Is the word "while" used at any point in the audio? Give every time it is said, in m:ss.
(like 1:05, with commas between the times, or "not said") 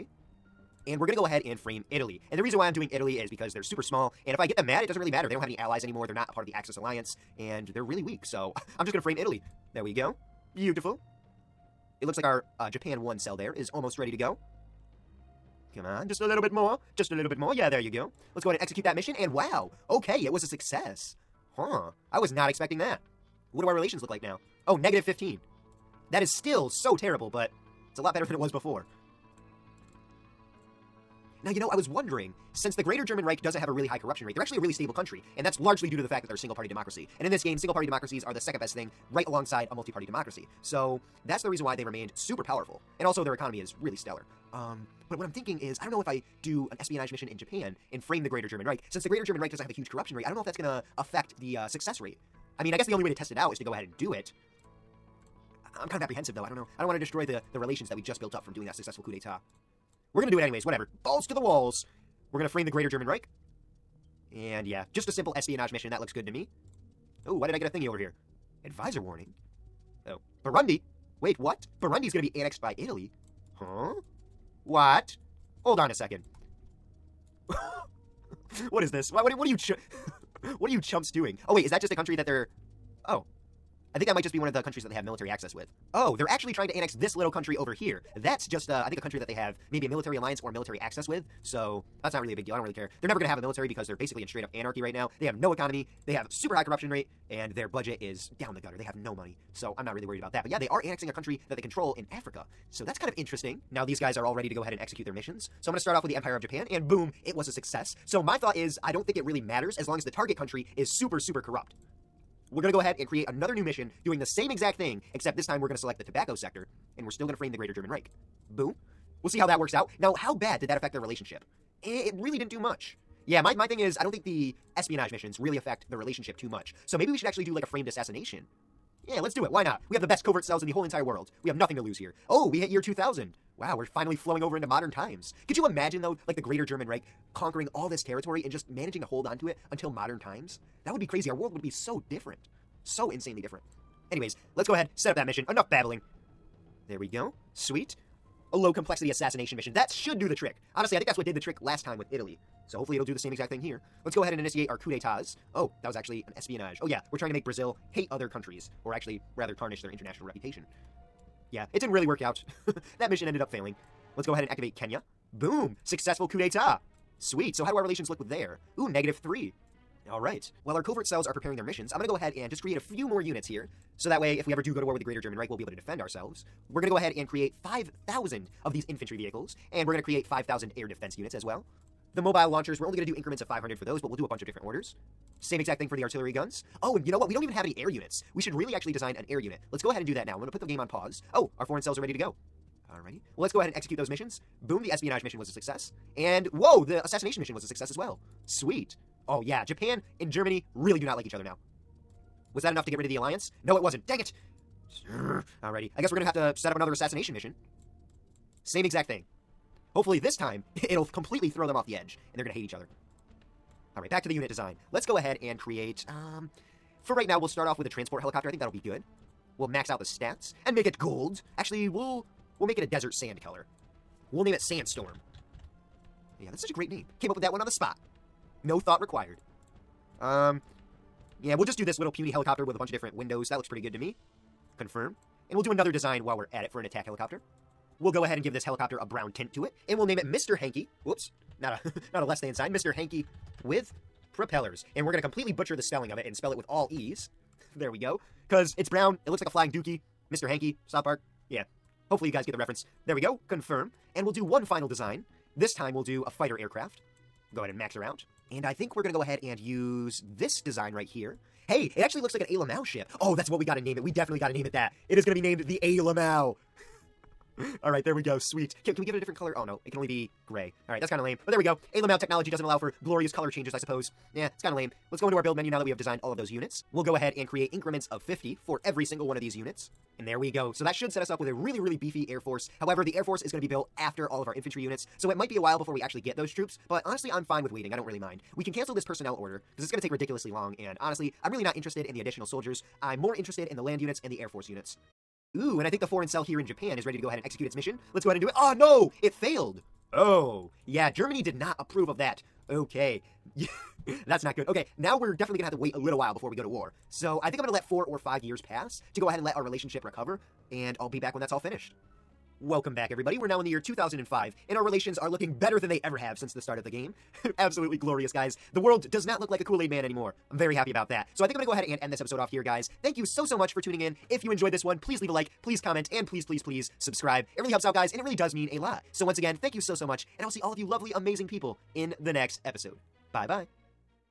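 2:50, 3:56, 4:45, 5:06.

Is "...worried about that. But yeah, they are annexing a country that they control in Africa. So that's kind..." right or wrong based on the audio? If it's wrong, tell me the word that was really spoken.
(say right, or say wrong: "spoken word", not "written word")
right.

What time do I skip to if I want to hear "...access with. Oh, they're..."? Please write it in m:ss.
1:25.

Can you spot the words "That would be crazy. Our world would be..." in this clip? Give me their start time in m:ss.
2:20.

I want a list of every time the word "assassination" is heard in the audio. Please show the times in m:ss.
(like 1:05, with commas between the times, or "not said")
2:07, 2:29, 3:17, 3:26.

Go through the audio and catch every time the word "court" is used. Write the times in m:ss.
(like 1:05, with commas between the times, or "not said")
not said.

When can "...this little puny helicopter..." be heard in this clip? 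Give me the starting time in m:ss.
3:51.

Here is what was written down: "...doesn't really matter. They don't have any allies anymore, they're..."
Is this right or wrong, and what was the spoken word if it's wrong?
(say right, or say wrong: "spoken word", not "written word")
right.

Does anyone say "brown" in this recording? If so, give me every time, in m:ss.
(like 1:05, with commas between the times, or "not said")
3:59, 4:08.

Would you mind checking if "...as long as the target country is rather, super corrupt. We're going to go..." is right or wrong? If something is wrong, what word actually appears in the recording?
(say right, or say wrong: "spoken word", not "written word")
wrong: "super", not "rather".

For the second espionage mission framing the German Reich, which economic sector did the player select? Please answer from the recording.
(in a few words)
Tobacco.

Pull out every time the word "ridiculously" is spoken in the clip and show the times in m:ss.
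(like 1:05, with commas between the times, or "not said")
4:50.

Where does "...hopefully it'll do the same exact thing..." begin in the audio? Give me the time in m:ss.
2:32.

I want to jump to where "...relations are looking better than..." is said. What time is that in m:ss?
5:14.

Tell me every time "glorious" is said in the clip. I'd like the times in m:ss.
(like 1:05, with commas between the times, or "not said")
4:33, 5:17.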